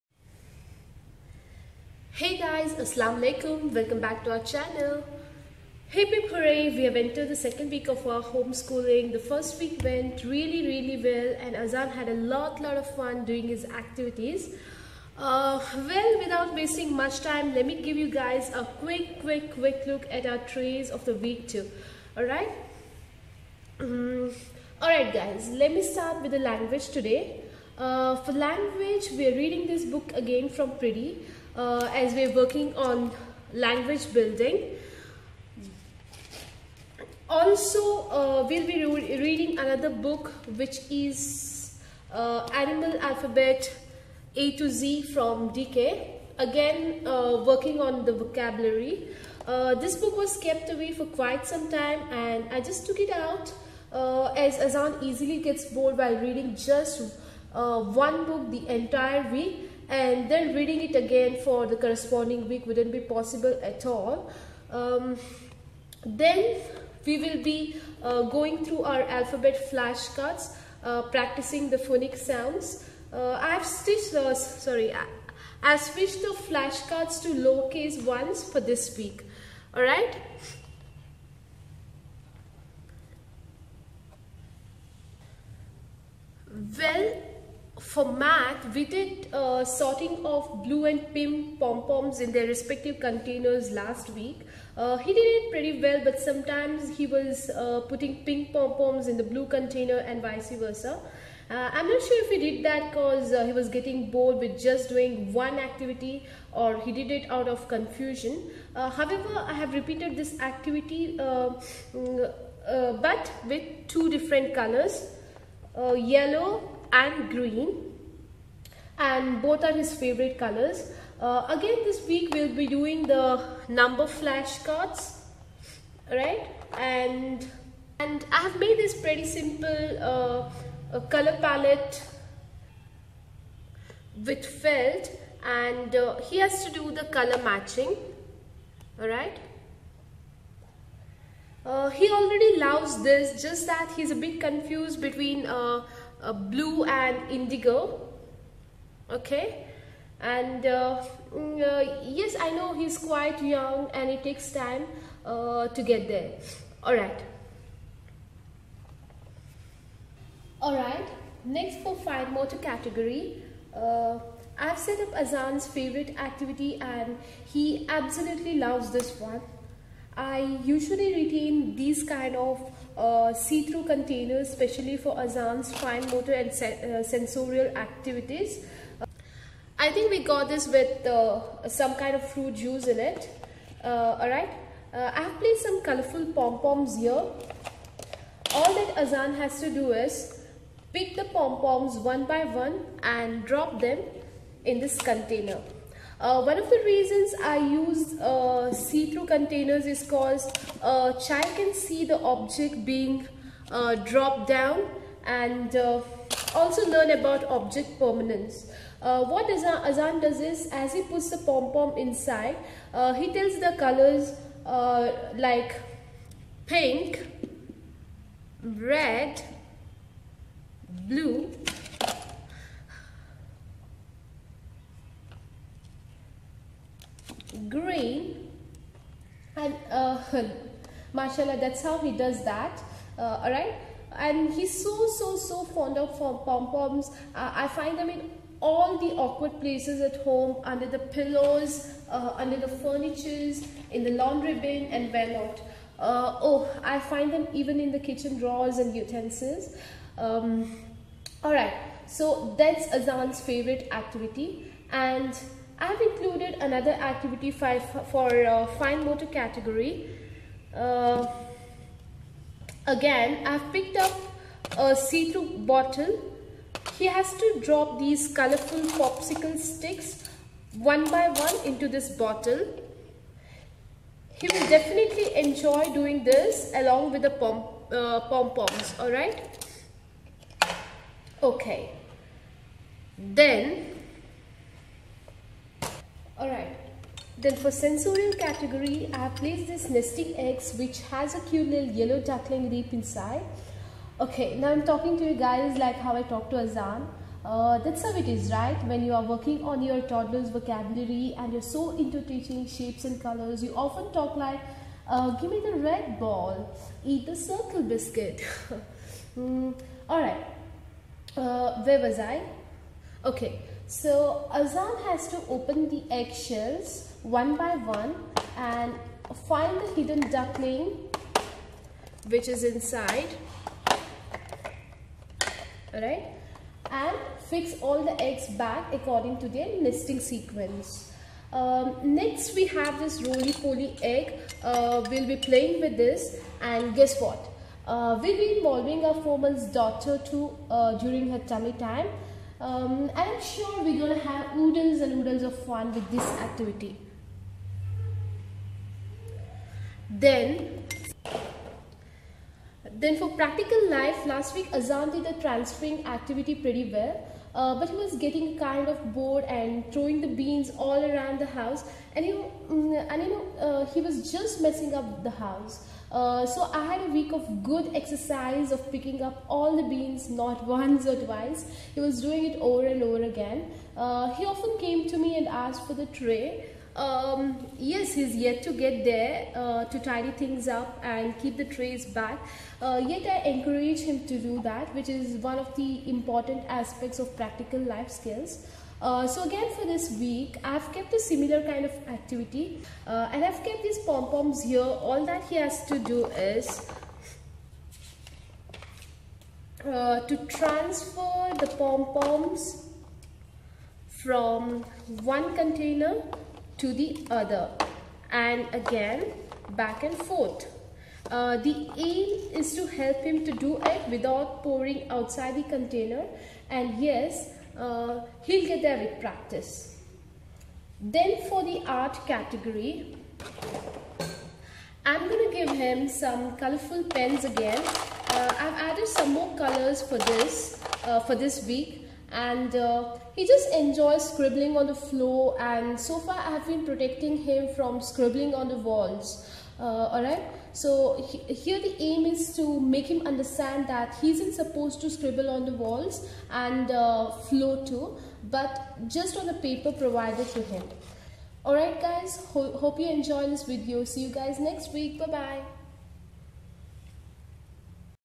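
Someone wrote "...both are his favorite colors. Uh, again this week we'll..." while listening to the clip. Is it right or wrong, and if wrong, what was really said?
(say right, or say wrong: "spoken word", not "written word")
right.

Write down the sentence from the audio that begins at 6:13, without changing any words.
Uh, he often came to me and asked for the tray.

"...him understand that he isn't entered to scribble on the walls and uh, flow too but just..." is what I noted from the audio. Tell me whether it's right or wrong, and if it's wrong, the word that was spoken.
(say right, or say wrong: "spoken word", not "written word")
wrong: "supposed", not "entered".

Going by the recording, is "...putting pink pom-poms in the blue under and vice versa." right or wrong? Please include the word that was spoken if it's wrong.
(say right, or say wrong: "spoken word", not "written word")
wrong: "container", not "under".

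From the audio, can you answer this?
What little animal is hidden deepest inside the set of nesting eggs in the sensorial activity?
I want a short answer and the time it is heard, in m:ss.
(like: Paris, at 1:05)
yellow duckling, at 4:51.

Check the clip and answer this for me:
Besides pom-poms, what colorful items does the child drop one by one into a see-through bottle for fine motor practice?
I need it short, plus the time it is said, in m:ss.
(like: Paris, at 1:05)
popsicle sticks, at 4:28.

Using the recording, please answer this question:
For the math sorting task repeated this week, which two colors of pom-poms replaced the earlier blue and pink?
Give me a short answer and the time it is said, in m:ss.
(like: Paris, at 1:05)
yellow and green, at 1:55.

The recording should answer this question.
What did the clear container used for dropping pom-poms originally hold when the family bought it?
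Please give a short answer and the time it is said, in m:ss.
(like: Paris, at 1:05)
fruit juice, at 3:02.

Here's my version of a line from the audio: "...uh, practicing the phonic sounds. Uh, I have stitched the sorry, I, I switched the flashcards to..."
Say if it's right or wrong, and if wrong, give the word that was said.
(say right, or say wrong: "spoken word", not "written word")
right.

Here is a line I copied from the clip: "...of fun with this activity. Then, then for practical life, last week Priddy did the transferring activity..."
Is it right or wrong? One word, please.
wrong.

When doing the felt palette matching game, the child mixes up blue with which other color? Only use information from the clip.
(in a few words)
indigo.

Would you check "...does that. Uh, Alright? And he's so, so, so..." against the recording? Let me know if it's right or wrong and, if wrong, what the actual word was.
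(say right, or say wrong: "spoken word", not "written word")
right.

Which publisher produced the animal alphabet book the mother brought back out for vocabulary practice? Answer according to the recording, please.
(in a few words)
DK.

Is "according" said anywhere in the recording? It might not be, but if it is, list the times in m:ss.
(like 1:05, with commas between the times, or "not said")
5:28.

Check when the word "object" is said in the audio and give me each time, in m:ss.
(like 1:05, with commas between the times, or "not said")
3:22, 3:27.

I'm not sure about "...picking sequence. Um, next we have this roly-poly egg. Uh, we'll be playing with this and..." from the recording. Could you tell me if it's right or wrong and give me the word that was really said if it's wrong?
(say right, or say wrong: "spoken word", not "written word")
wrong: "nesting", not "picking".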